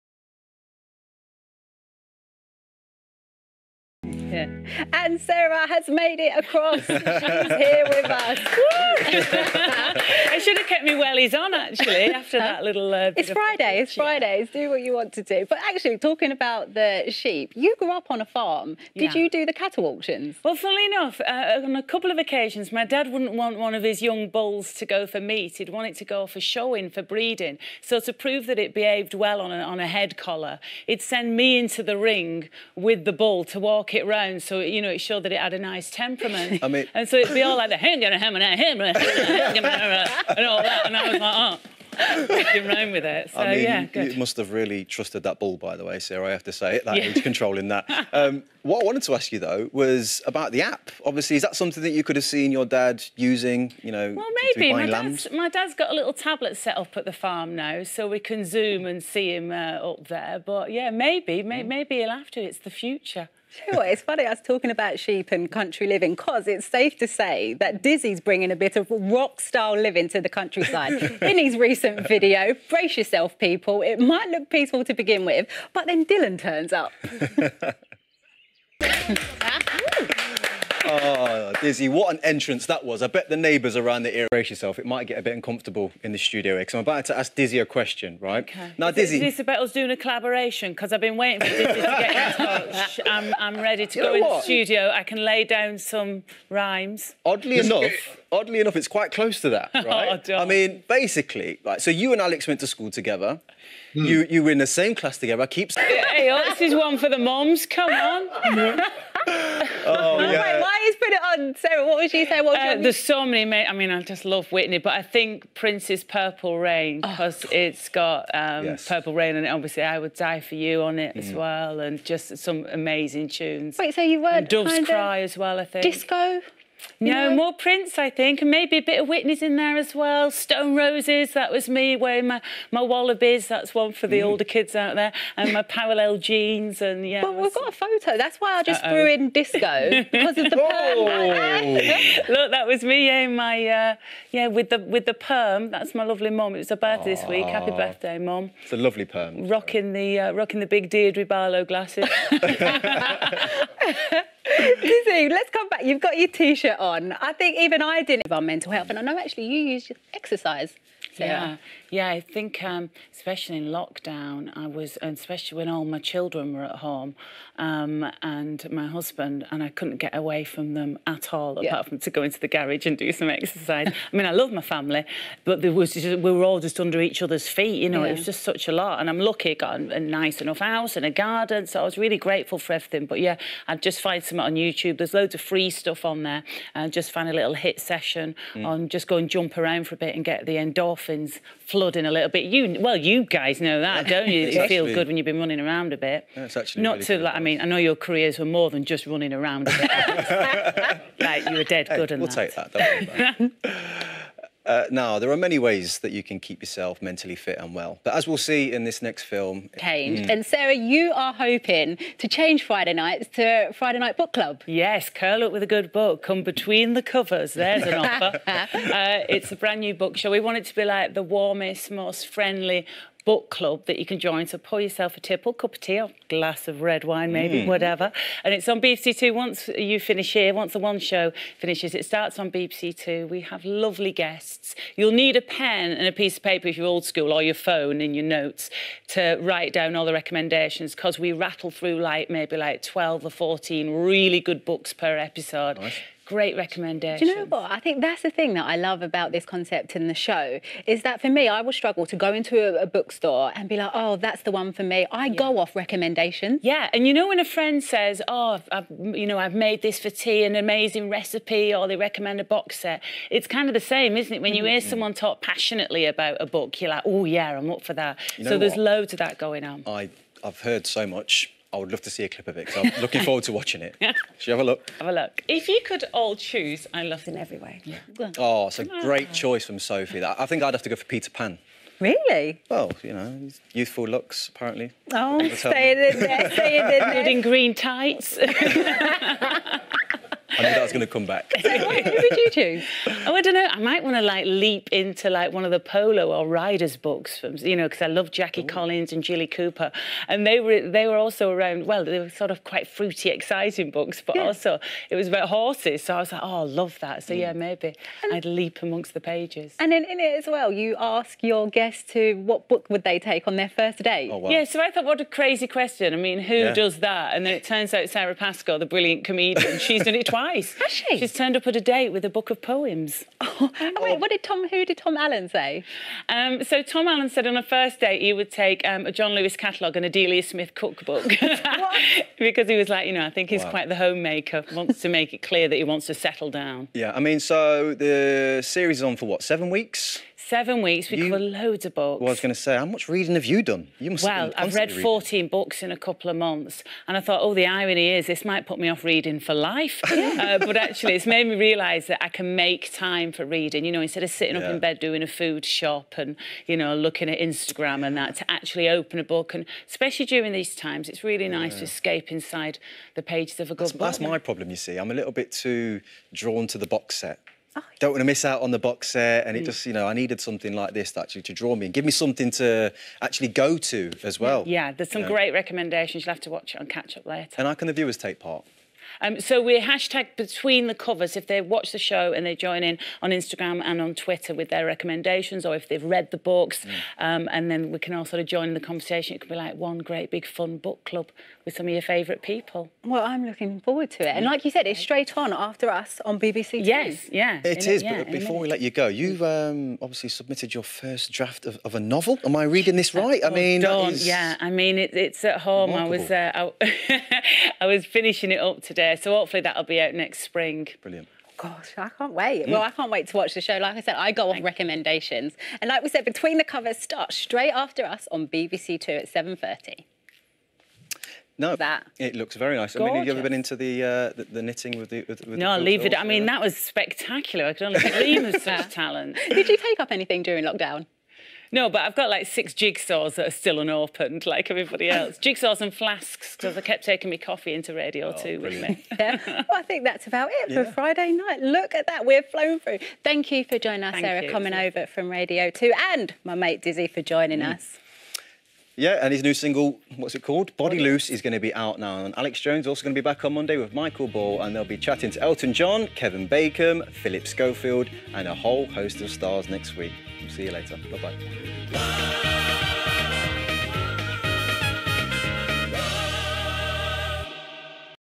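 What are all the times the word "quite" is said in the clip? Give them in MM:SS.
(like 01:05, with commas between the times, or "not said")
01:38, 05:02, 05:33.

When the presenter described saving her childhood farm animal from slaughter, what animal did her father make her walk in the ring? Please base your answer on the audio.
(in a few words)
Bull.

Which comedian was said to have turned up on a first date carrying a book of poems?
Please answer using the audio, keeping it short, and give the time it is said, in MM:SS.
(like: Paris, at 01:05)
Sara Pascoe, at 05:18.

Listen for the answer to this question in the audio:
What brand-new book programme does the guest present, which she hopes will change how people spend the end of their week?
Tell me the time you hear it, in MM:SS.
03:33.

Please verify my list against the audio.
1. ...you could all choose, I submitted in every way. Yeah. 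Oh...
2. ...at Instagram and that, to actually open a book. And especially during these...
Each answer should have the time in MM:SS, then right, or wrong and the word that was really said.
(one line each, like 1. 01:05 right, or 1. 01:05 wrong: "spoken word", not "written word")
1. 04:35 wrong: "loved", not "submitted"
2. 05:57 right.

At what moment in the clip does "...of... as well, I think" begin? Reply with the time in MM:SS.
02:05.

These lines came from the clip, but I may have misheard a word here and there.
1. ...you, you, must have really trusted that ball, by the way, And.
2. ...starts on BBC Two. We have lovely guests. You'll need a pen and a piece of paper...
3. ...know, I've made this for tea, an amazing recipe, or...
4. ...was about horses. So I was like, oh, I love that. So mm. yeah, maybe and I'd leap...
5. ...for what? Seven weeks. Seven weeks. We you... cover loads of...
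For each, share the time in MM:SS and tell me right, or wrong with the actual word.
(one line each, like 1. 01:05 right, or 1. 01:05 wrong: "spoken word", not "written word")
1. 00:43 wrong: "Sara", not "And"
2. 03:52 right
3. 04:19 right
4. 05:05 right
5. 05:39 right.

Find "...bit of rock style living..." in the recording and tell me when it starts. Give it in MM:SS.
01:08.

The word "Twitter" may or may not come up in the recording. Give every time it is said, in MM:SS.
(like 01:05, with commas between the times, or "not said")
06:24.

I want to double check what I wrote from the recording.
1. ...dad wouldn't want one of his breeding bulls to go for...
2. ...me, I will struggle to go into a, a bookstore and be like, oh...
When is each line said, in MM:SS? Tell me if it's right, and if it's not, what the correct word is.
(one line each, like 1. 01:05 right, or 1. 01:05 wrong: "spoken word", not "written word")
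1. 00:22 wrong: "young", not "breeding"
2. 04:11 right.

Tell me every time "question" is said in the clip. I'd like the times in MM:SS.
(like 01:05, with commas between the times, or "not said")
01:27, 05:15.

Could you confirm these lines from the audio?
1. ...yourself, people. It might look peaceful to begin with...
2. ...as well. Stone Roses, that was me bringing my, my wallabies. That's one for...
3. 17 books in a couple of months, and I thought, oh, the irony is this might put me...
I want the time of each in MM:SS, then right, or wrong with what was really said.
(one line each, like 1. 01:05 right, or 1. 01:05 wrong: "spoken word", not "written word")
1. 01:12 right
2. 02:09 wrong: "wearing", not "bringing"
3. 05:45 wrong: "14", not "17".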